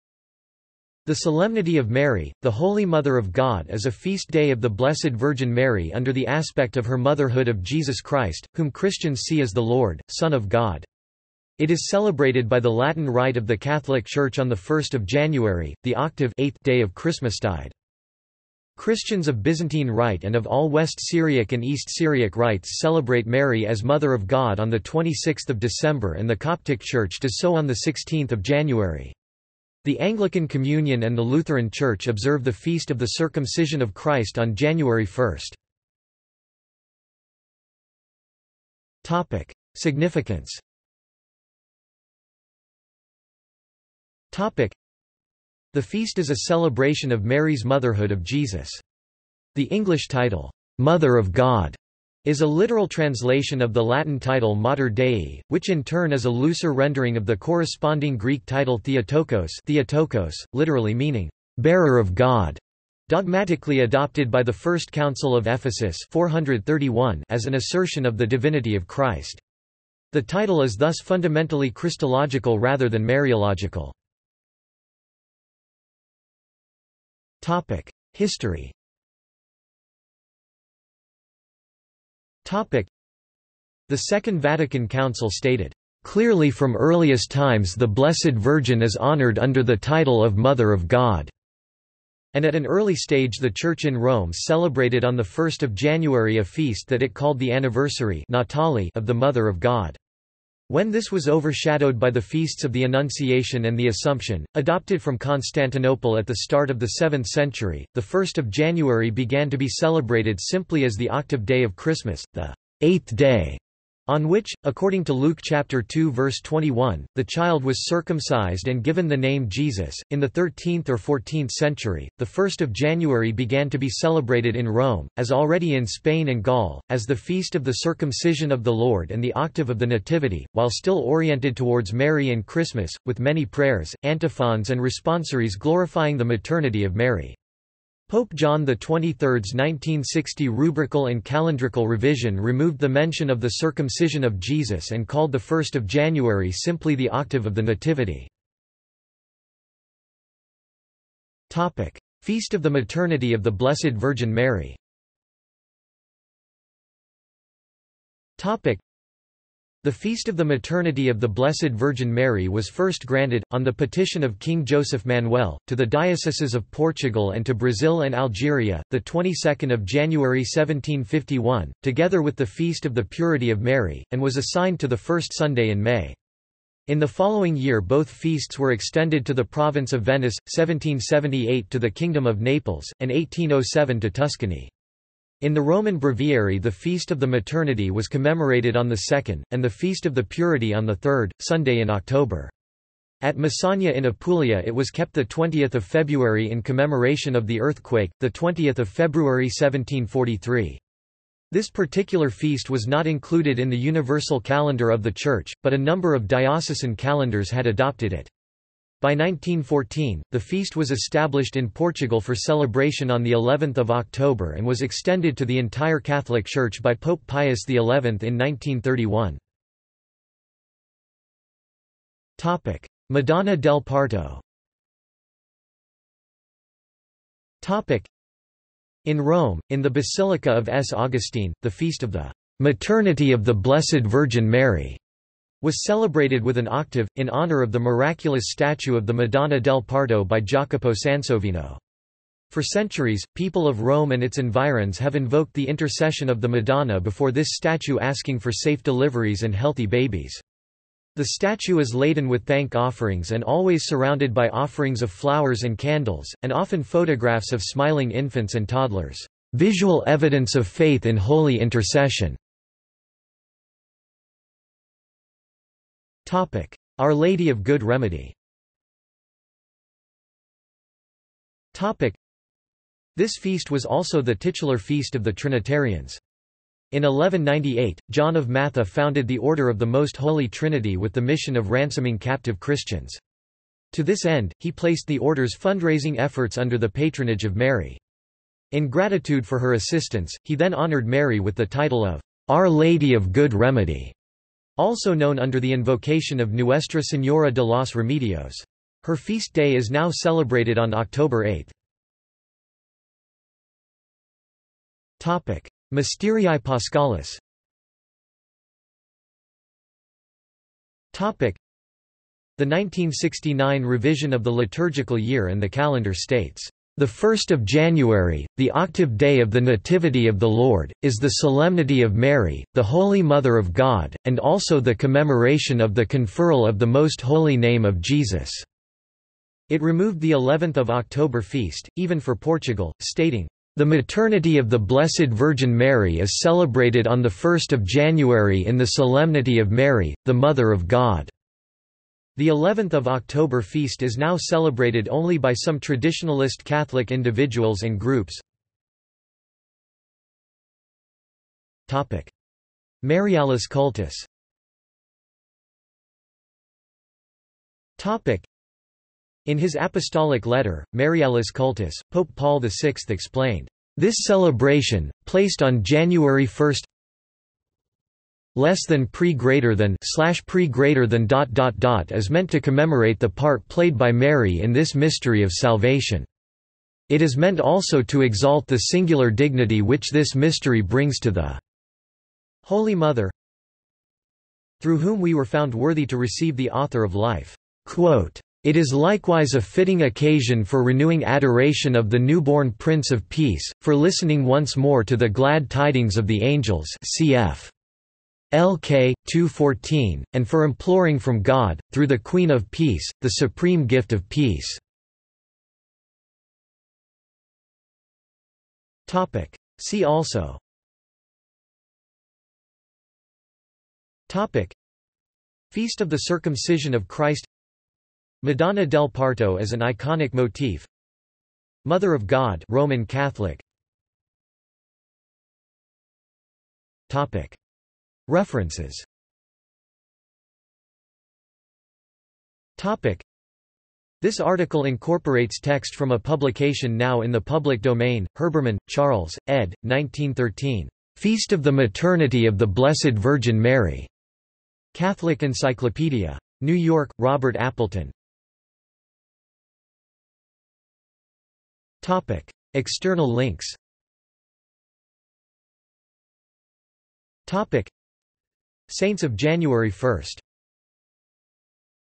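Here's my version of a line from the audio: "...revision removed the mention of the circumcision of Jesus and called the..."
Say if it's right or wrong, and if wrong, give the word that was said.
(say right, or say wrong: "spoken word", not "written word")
right.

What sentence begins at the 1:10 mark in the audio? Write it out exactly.
The title is thus fundamentally Christological rather than Mariological.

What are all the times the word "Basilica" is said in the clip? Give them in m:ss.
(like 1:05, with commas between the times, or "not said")
3:49.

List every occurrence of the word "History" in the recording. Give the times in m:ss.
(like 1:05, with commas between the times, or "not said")
1:18.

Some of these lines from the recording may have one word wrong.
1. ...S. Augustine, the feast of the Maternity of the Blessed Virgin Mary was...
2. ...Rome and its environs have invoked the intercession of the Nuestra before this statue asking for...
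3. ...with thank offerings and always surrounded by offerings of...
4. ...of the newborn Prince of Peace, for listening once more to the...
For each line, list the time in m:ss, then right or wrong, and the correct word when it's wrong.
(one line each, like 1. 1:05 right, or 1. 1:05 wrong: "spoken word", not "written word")
1. 3:50 right
2. 4:03 wrong: "Madonna", not "Nuestra"
3. 4:12 right
4. 6:31 right.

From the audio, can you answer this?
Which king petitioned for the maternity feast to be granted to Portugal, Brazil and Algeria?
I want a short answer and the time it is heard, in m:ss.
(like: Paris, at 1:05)
King Joseph Manuel, at 2:44.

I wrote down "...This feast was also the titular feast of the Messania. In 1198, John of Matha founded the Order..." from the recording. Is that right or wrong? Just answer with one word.
wrong.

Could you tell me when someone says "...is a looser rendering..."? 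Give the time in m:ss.
0:56.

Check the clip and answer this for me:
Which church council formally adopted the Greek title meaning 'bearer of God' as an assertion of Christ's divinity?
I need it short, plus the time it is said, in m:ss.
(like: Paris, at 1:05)
First Council of Ephesus, at 1:04.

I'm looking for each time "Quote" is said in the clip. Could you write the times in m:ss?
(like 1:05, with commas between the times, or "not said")
6:27.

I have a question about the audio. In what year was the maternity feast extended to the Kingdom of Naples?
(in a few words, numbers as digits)
1778.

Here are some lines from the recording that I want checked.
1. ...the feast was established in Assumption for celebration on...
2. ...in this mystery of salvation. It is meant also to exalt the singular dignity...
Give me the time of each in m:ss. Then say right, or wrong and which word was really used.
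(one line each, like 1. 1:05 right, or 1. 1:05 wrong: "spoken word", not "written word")
1. 3:30 wrong: "Portugal", not "Assumption"
2. 6:14 right.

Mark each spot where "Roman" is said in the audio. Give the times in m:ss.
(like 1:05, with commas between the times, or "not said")
3:05, 7:02.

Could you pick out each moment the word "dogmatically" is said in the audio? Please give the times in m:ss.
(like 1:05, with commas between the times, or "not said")
1:03.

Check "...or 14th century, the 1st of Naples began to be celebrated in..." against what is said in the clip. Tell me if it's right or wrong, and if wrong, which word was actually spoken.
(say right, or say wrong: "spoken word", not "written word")
wrong: "January", not "Naples".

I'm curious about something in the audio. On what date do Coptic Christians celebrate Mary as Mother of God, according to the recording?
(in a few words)
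16 January.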